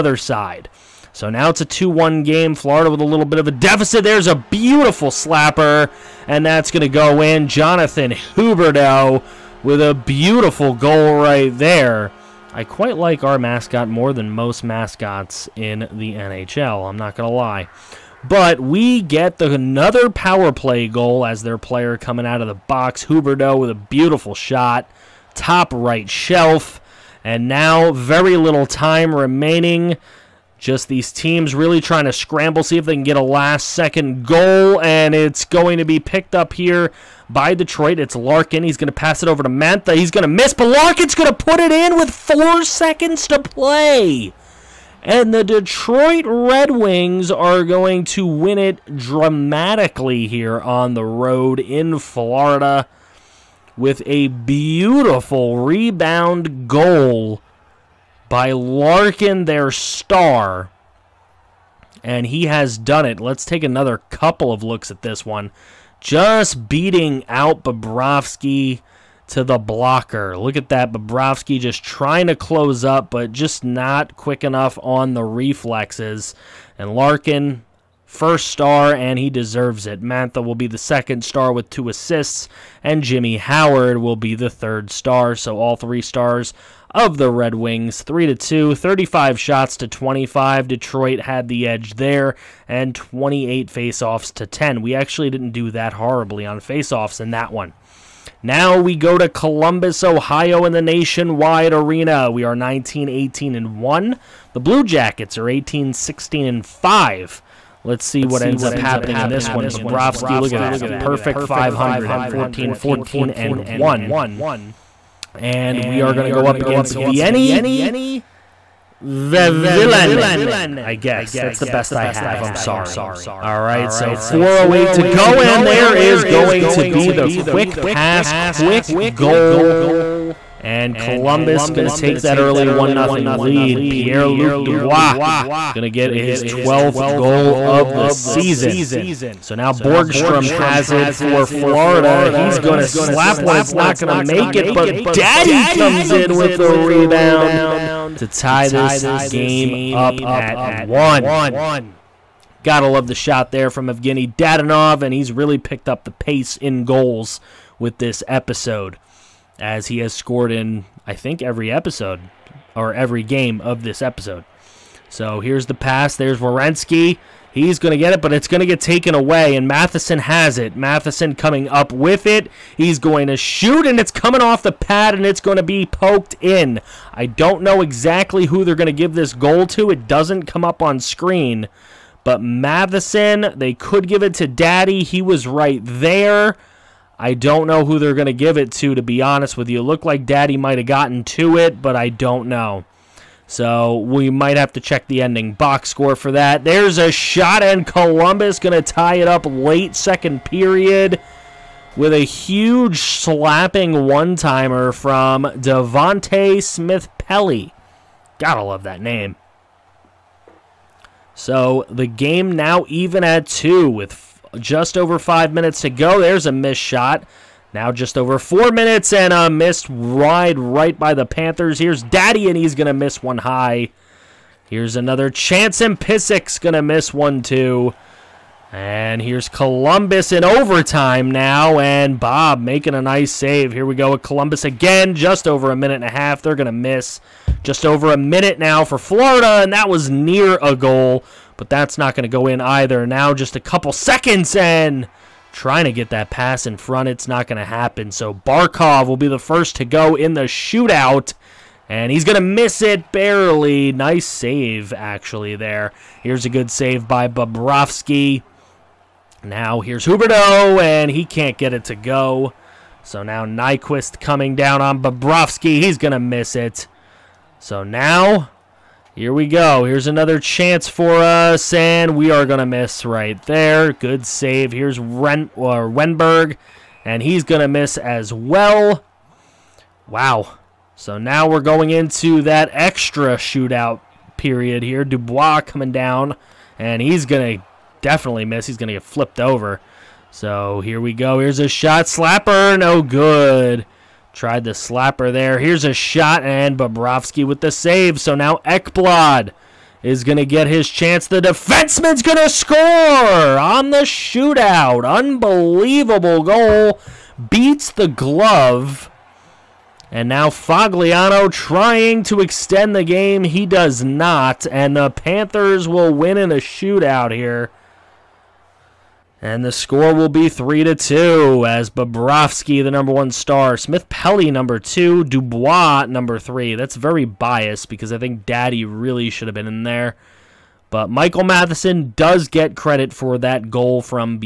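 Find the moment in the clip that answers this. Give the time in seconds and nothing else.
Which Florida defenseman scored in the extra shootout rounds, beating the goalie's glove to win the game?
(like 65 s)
298 s.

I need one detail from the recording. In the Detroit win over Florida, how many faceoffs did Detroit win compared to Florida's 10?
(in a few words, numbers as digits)
28.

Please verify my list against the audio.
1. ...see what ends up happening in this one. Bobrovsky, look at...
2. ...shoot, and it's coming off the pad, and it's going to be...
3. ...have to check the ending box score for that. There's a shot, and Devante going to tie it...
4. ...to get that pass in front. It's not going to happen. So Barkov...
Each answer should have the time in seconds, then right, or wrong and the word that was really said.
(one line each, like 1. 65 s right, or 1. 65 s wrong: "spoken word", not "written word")
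1. 108 s right
2. 173 s right
3. 194 s wrong: "Columbus", not "Devante"
4. 245 s right.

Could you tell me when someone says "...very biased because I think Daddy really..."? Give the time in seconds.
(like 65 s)
326 s.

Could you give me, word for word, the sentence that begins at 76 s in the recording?
And Larkin, first star, and he deserves it.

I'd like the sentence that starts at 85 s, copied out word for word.
So all three stars of the Red Wings, 3 to 2, 35 shots to 25.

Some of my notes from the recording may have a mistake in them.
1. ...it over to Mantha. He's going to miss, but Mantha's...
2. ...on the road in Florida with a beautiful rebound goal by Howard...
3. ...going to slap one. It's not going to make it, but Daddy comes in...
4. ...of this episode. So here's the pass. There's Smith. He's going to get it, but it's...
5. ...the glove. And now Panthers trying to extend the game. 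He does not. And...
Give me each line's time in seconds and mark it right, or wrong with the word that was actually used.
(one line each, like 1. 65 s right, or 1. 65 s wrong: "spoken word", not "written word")
1. 39 s wrong: "Larkin", not "Mantha"
2. 50 s wrong: "Larkin", not "Howard"
3. 142 s right
4. 163 s wrong: "Werenski", not "Smith"
5. 307 s wrong: "Foligno", not "Panthers".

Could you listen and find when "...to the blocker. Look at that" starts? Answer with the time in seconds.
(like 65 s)
69 s.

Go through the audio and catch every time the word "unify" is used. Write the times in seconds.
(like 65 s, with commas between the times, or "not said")
not said.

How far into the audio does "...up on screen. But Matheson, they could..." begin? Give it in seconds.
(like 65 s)
180 s.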